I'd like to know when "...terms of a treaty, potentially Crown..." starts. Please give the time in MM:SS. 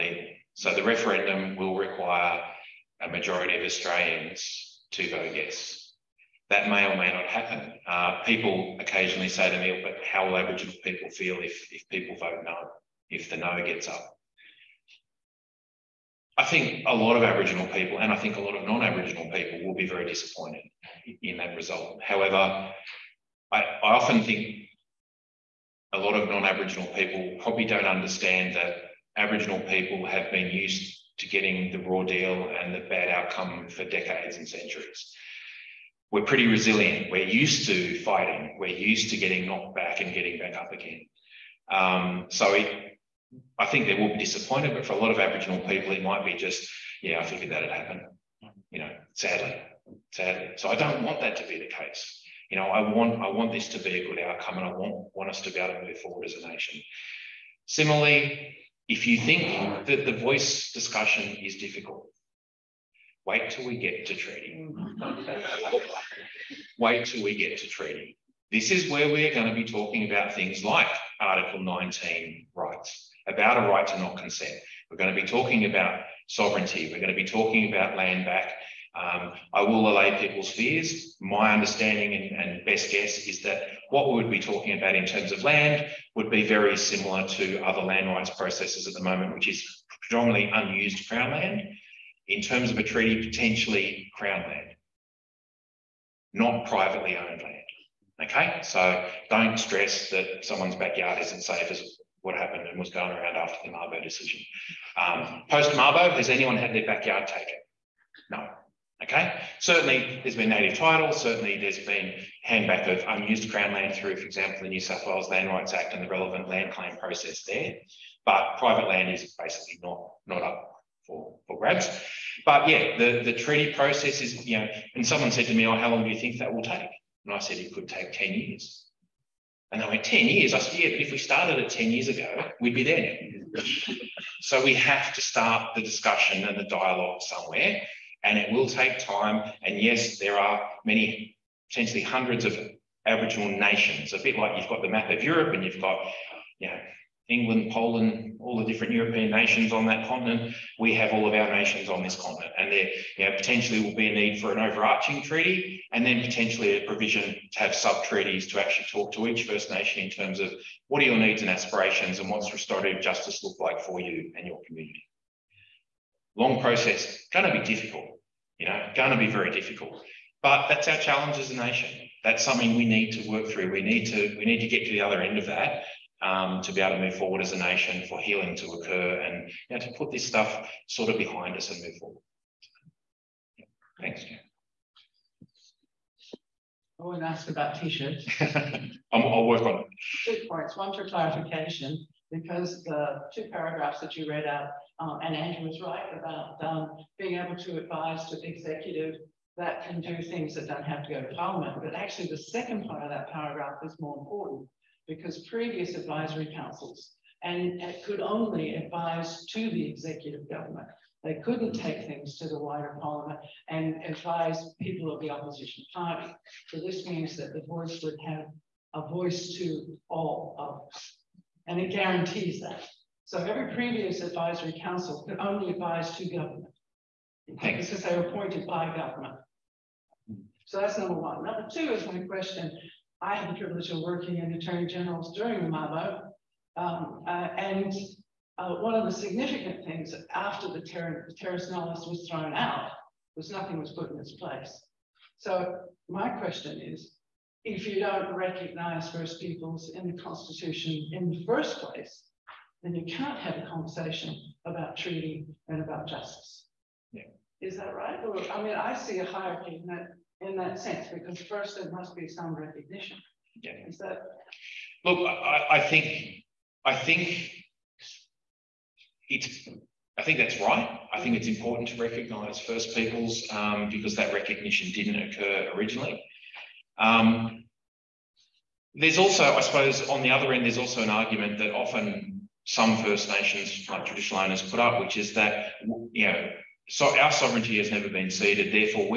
01:32.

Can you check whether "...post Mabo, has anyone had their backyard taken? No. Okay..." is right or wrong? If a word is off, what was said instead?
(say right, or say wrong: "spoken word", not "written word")
right.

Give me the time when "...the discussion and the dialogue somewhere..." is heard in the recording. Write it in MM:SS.
02:15.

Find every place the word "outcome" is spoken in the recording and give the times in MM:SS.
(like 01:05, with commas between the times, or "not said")
00:33, 00:54.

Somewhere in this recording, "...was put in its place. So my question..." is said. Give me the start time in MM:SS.
04:03.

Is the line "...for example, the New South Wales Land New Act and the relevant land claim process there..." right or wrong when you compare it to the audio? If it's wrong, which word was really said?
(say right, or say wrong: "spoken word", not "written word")
wrong: "Rights", not "New".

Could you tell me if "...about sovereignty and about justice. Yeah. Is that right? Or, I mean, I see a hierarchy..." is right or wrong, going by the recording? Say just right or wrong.
wrong.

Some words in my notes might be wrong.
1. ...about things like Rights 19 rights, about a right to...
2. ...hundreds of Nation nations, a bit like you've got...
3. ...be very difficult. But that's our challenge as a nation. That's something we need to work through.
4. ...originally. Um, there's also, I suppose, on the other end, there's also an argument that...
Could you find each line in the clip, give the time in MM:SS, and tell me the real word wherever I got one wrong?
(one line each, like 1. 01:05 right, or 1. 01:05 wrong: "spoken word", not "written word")
1. 01:10 wrong: "Article", not "Rights"
2. 02:22 wrong: "Aboriginal", not "Nation"
3. 02:49 right
4. 04:35 right.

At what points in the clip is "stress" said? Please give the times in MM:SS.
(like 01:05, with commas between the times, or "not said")
01:39.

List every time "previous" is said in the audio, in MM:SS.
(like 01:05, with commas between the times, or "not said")
03:25, 03:43.